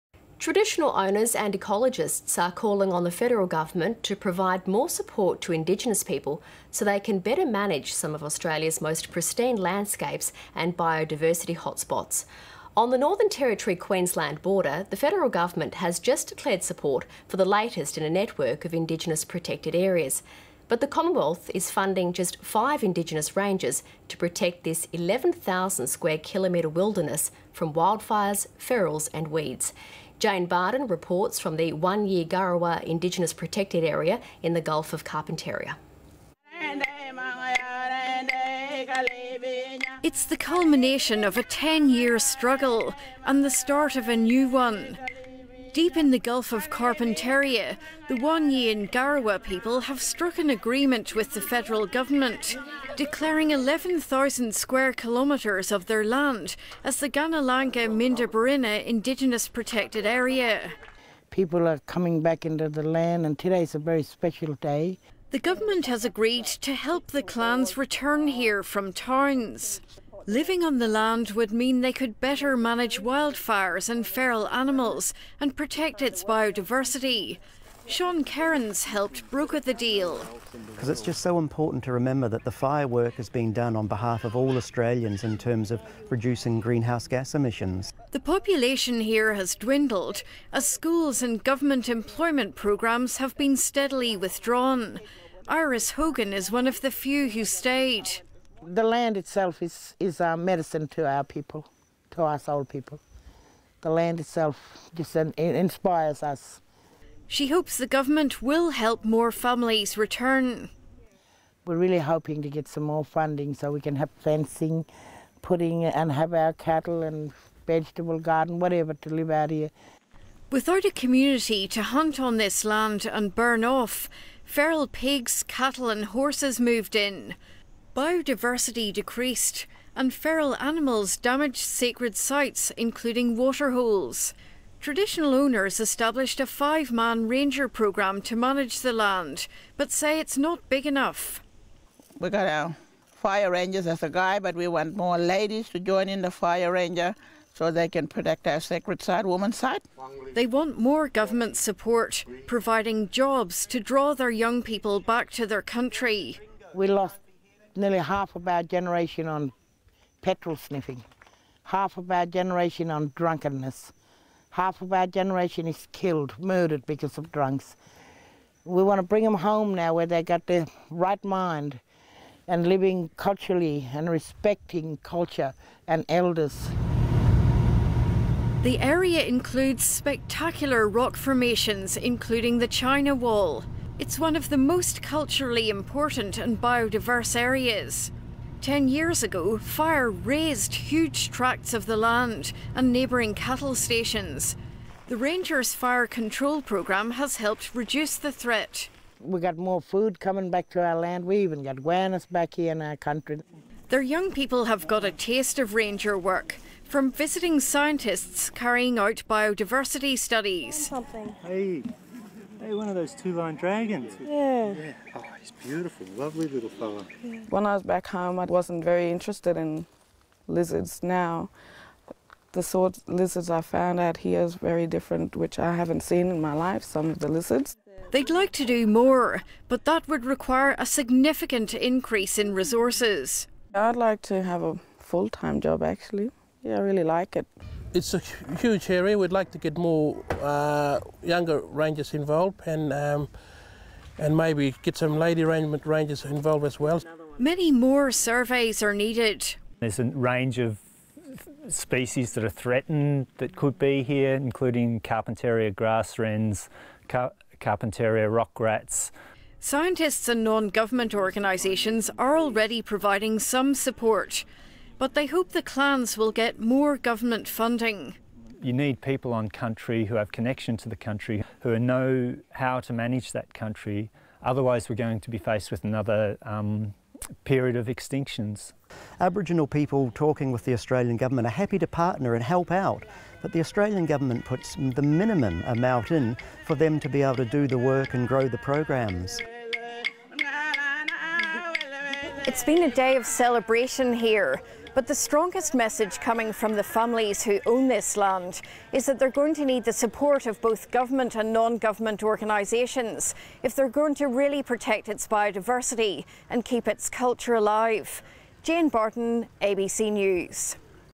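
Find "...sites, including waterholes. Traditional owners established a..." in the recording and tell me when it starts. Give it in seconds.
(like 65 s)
132 s.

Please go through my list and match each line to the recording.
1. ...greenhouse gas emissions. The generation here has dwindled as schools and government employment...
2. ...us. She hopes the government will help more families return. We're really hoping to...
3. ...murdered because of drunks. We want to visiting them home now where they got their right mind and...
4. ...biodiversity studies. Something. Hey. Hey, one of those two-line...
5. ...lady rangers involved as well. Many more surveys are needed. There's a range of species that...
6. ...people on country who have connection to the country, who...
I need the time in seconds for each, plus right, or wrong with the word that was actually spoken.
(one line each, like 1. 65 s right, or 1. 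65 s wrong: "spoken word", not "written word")
1. 86 s wrong: "population", not "generation"
2. 106 s right
3. 166 s wrong: "bring", not "visiting"
4. 209 s right
5. 245 s right
6. 269 s right.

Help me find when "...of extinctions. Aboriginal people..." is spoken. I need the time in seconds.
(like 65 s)
277 s.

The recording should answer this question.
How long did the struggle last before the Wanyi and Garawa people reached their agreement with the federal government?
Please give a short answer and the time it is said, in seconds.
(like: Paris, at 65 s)
10 years, at 41 s.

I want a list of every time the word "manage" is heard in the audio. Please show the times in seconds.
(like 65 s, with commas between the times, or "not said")
7 s, 72 s, 138 s, 272 s.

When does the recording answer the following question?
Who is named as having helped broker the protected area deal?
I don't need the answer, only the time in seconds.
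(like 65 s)
77 s.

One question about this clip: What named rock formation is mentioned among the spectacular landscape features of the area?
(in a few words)
China Wall.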